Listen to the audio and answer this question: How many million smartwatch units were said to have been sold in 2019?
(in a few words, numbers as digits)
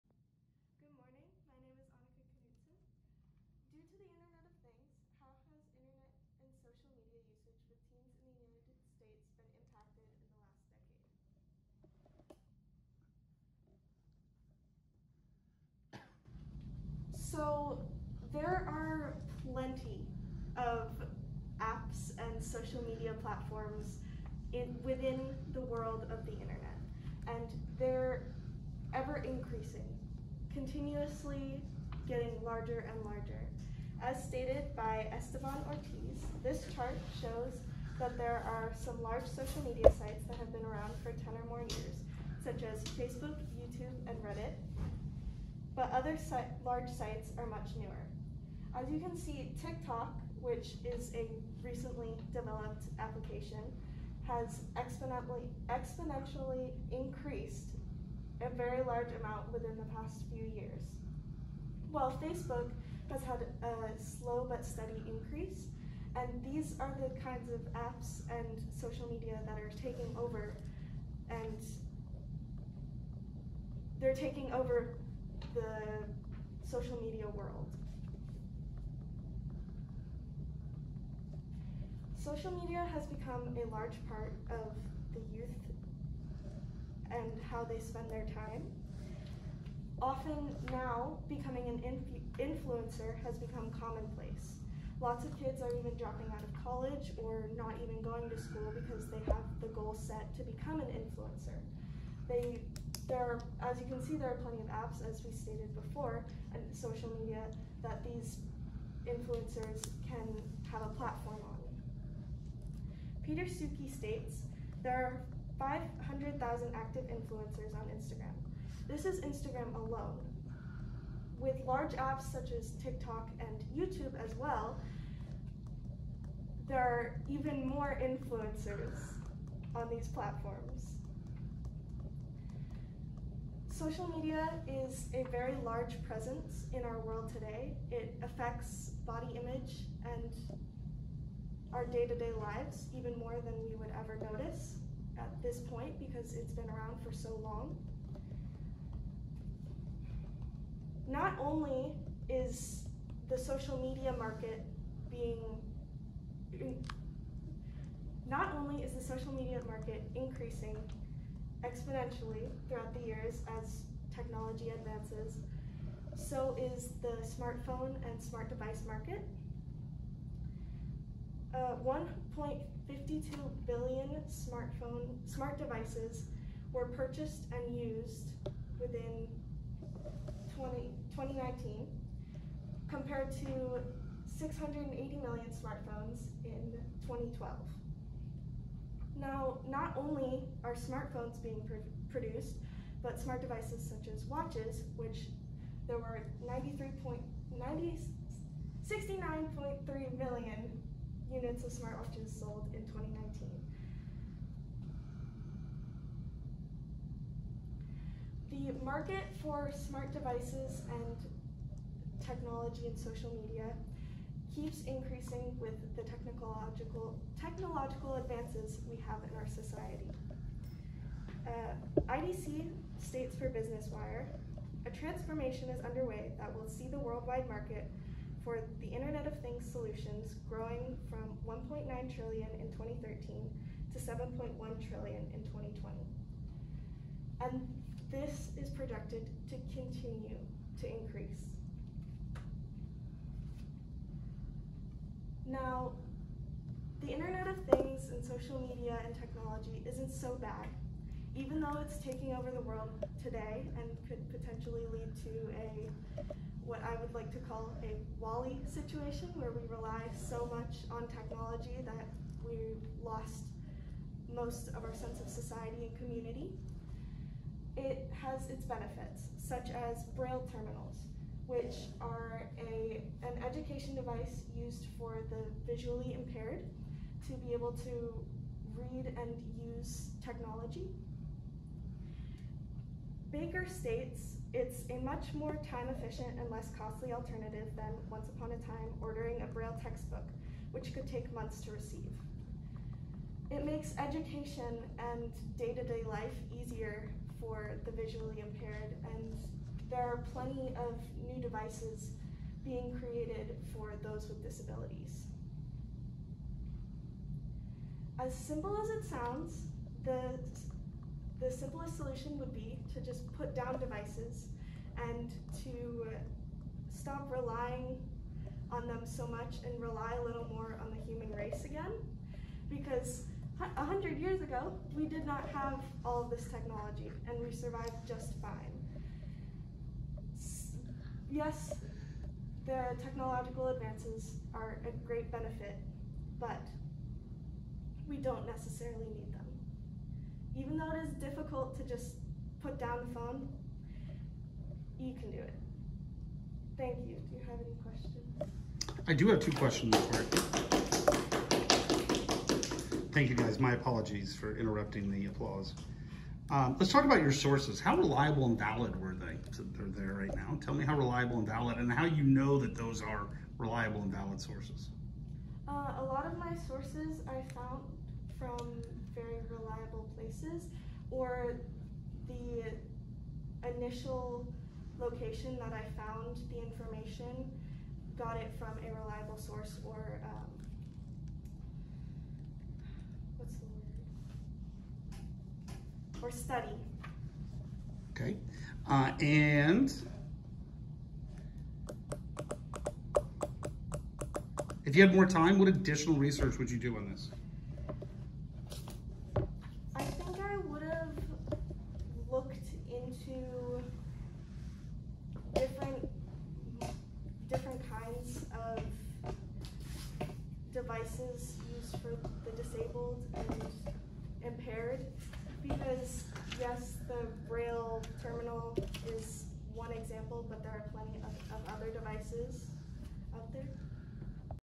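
93.90 million.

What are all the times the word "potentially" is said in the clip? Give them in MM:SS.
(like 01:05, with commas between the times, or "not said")
04:14.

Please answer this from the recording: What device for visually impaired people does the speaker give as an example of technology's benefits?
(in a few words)
braille terminals.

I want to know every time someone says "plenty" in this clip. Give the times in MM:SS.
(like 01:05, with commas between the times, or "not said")
00:19, 01:44, 05:00, 07:00.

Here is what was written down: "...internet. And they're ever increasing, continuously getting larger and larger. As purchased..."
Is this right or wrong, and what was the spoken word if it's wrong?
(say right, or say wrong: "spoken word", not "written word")
wrong: "stated", not "purchased".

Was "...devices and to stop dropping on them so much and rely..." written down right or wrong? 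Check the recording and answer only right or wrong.
wrong.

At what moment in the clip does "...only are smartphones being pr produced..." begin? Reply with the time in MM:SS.
03:09.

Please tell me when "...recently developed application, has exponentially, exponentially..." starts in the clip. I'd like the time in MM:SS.
00:51.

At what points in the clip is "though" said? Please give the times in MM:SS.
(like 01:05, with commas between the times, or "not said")
04:11, 05:40.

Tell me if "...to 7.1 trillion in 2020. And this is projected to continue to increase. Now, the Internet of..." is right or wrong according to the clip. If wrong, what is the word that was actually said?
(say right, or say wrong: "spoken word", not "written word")
right.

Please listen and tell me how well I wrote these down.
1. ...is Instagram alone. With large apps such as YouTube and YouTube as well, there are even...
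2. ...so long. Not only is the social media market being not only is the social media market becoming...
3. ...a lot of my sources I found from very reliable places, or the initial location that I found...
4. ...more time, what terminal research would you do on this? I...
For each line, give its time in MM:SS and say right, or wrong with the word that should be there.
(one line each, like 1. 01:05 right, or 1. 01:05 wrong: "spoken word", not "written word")
1. 01:59 wrong: "TikTok", not "YouTube"
2. 02:27 wrong: "increasing", not "becoming"
3. 06:05 right
4. 06:35 wrong: "additional", not "terminal".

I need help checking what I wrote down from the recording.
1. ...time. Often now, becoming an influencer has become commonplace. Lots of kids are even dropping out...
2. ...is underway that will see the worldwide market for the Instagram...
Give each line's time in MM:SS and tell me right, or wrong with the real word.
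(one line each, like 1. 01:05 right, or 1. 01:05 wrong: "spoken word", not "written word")
1. 01:28 right
2. 03:45 wrong: "Internet", not "Instagram".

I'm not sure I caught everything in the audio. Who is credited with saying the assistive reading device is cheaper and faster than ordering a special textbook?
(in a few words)
Baker.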